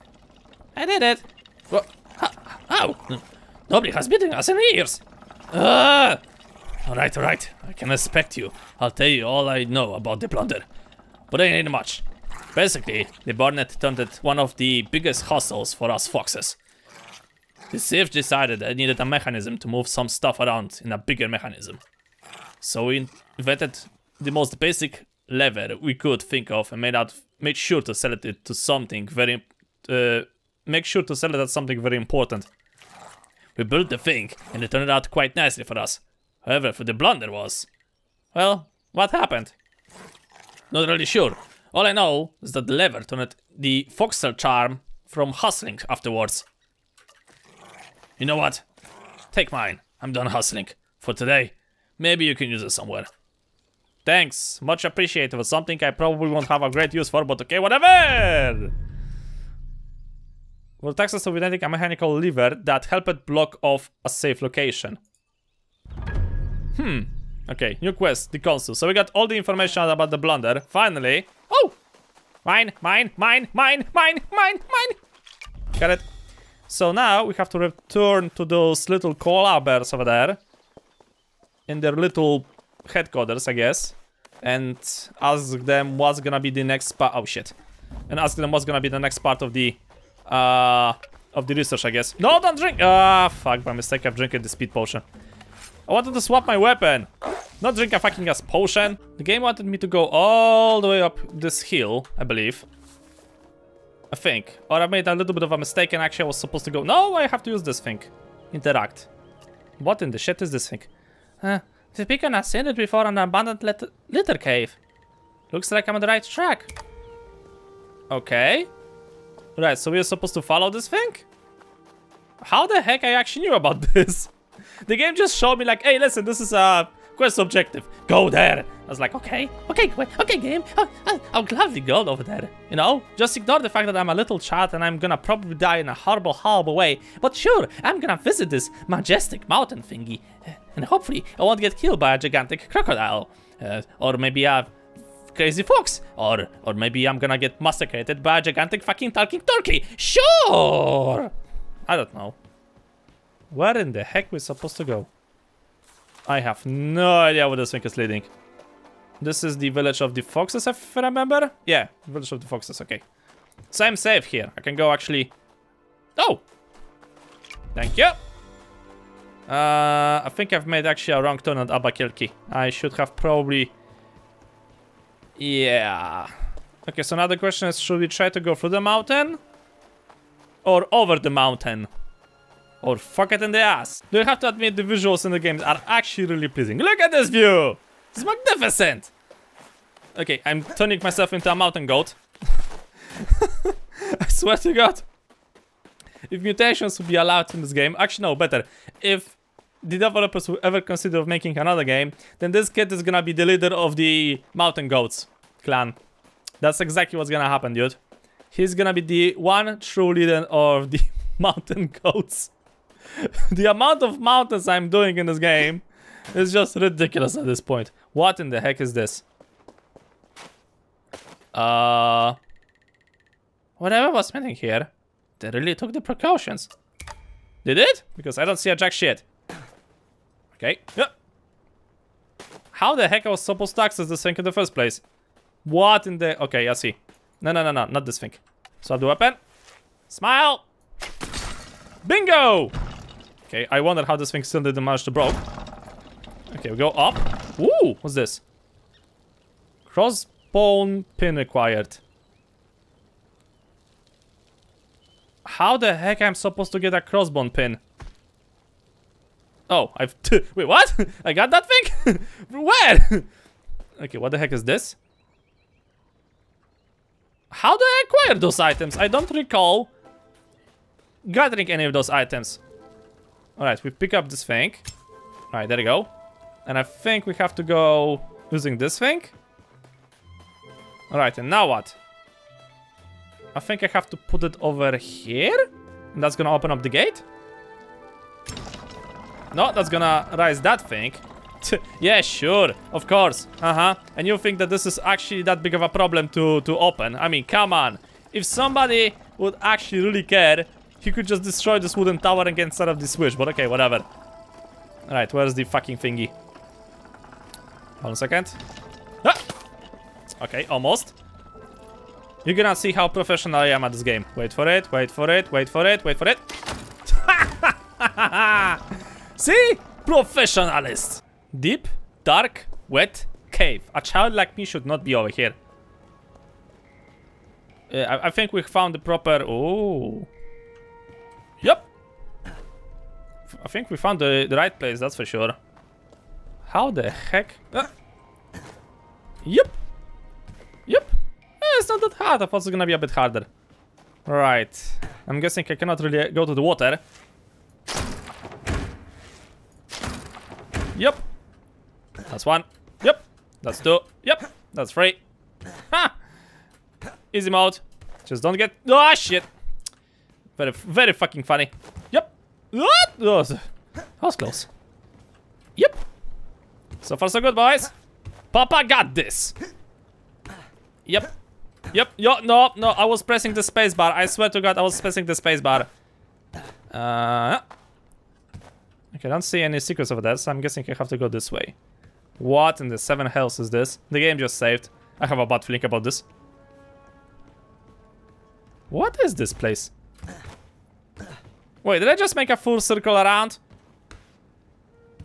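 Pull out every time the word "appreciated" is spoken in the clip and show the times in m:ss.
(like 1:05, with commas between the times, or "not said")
0:54.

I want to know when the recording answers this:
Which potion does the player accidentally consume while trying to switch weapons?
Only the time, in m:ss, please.
1:34.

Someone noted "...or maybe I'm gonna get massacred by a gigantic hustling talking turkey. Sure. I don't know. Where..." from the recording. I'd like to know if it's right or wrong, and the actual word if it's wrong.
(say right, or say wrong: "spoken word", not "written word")
wrong: "fucking", not "hustling".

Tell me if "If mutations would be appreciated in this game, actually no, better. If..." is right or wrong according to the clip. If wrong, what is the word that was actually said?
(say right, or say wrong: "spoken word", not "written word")
wrong: "allowed", not "appreciated".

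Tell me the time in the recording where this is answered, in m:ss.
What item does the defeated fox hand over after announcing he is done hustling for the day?
0:43.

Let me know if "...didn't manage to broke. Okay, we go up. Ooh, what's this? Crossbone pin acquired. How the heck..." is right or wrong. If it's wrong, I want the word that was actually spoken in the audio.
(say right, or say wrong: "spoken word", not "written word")
right.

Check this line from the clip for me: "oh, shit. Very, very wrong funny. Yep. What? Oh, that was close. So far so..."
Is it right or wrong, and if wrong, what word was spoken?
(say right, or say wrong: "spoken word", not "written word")
wrong: "fucking", not "wrong".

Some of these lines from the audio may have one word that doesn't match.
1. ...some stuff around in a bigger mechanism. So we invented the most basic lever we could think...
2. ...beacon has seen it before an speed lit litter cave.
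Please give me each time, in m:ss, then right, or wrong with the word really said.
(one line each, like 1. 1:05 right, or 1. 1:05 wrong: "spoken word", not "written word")
1. 0:19 right
2. 1:52 wrong: "abandoned", not "speed".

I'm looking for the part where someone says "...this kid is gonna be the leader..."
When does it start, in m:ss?
3:22.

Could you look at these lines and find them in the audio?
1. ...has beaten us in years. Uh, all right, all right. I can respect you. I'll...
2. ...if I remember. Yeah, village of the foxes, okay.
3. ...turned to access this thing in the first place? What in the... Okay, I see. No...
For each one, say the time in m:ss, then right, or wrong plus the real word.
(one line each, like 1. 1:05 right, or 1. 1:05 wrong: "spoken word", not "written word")
1. 0:03 right
2. 2:40 right
3. 3:53 wrong: "supposed", not "turned".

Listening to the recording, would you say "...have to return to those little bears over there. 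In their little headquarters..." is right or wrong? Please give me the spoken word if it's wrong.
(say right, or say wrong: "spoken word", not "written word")
right.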